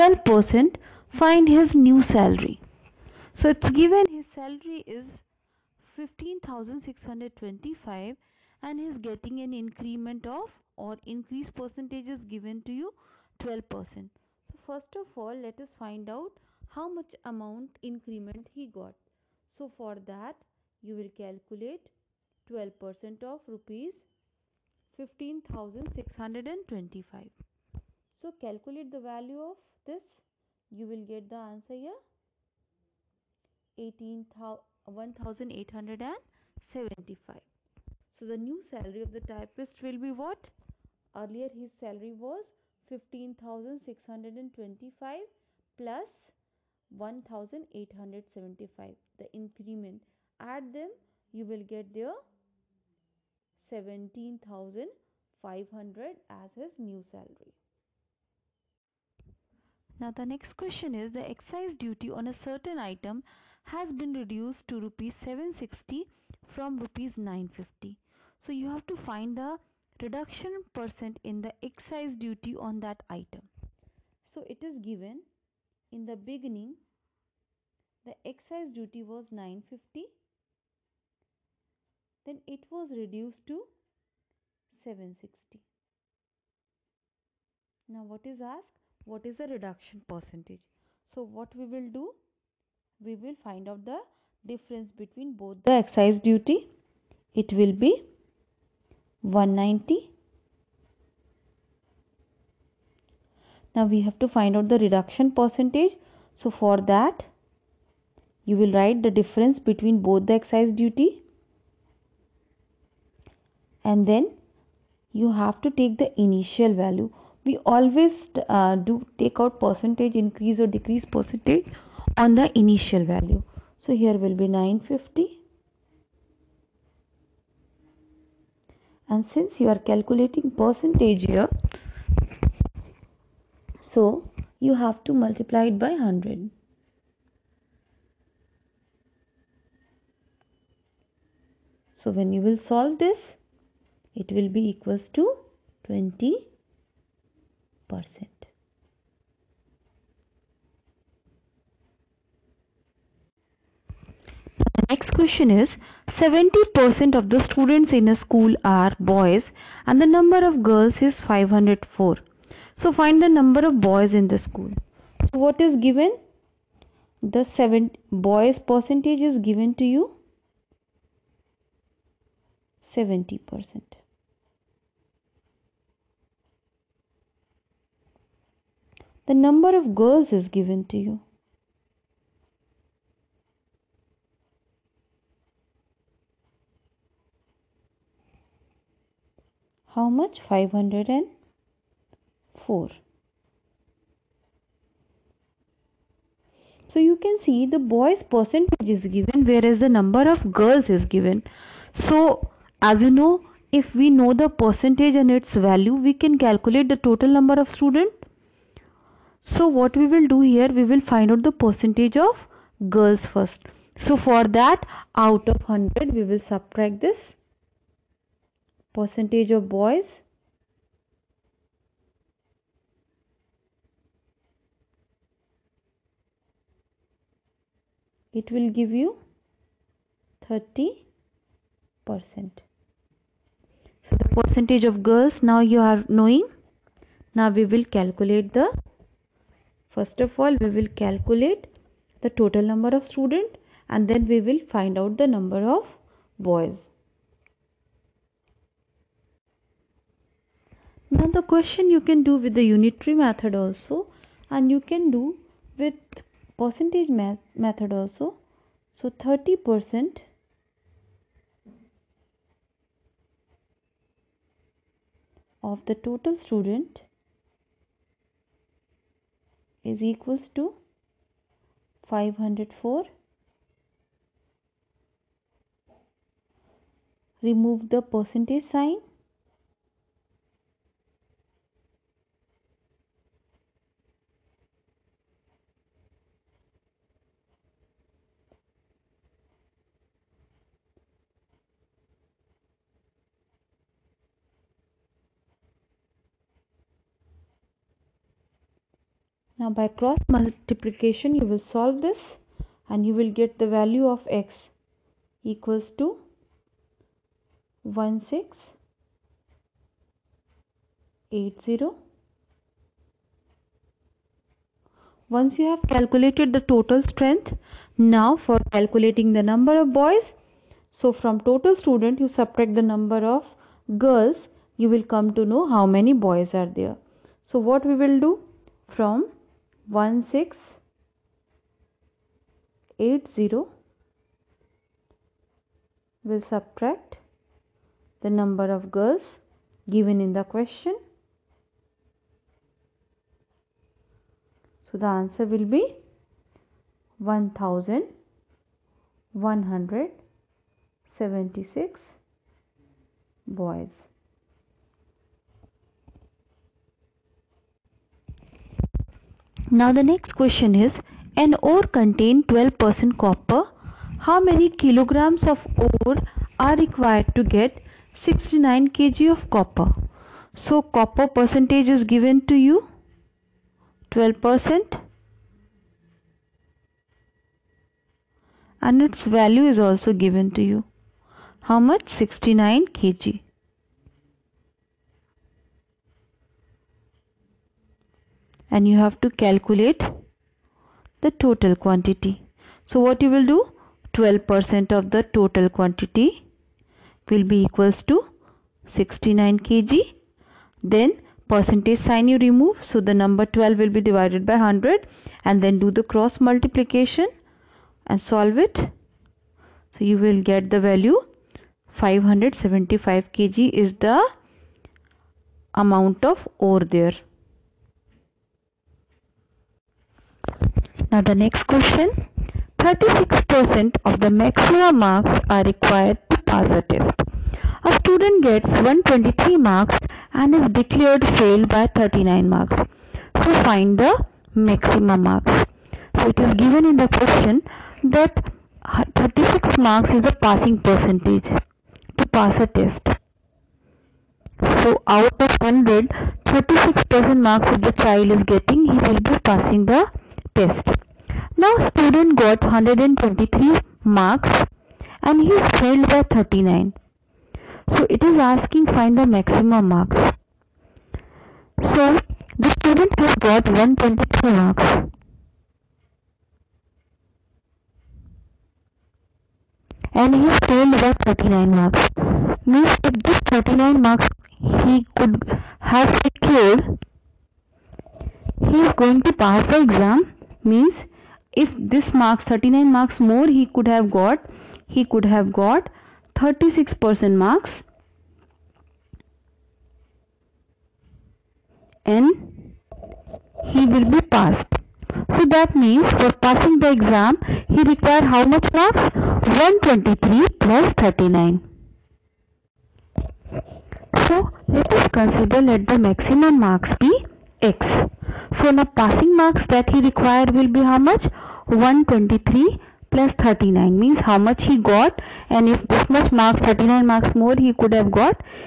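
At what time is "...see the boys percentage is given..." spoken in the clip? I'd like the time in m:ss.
3:17.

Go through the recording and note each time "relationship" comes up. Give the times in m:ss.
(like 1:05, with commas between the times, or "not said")
not said.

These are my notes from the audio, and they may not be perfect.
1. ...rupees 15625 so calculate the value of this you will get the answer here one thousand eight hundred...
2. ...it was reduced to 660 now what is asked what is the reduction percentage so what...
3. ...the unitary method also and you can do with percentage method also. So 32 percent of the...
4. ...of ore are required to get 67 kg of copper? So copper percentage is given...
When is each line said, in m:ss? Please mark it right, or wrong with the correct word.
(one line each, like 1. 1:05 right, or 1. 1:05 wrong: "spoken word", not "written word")
1. 0:23 right
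2. 1:22 wrong: "760", not "660"
3. 4:12 wrong: "30", not "32"
4. 6:05 wrong: "69", not "67".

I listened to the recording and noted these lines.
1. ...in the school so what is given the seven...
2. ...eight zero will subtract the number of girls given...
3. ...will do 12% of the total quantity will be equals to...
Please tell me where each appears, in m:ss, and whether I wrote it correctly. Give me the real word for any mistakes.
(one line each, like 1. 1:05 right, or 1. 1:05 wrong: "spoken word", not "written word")
1. 2:44 right
2. 5:32 right
3. 6:33 right.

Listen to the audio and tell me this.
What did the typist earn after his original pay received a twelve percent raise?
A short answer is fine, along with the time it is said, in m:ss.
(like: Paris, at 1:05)
17,500, at 0:53.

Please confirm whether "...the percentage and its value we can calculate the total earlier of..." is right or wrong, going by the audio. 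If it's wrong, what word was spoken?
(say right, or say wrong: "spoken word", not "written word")
wrong: "number", not "earlier".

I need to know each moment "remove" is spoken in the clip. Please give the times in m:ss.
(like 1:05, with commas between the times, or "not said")
4:37, 6:42.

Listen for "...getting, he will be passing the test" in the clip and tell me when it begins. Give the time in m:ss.
7:28.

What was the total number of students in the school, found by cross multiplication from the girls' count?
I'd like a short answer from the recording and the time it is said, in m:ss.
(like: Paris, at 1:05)
1680, at 5:07.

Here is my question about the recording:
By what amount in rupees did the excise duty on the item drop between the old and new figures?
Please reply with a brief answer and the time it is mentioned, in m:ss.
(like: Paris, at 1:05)
190, at 1:39.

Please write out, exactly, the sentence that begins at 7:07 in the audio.
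A student gets 123 marks and is declared failed by 39 marks.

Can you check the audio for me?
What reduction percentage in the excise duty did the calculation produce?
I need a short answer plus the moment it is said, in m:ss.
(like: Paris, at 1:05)
20 percent, at 2:25.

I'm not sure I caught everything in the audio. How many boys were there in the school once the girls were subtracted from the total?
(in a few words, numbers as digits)
1176.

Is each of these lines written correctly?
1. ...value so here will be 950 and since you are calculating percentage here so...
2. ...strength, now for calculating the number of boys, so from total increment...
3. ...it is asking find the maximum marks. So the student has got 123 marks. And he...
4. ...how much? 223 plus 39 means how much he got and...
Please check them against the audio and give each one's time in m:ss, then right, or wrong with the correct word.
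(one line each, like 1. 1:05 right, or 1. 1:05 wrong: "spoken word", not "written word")
1. 2:03 right
2. 5:17 wrong: "student", not "increment"
3. 7:38 right
4. 8:30 wrong: "123", not "223".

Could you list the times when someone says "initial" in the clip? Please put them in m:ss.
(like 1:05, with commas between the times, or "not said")
1:56, 2:02.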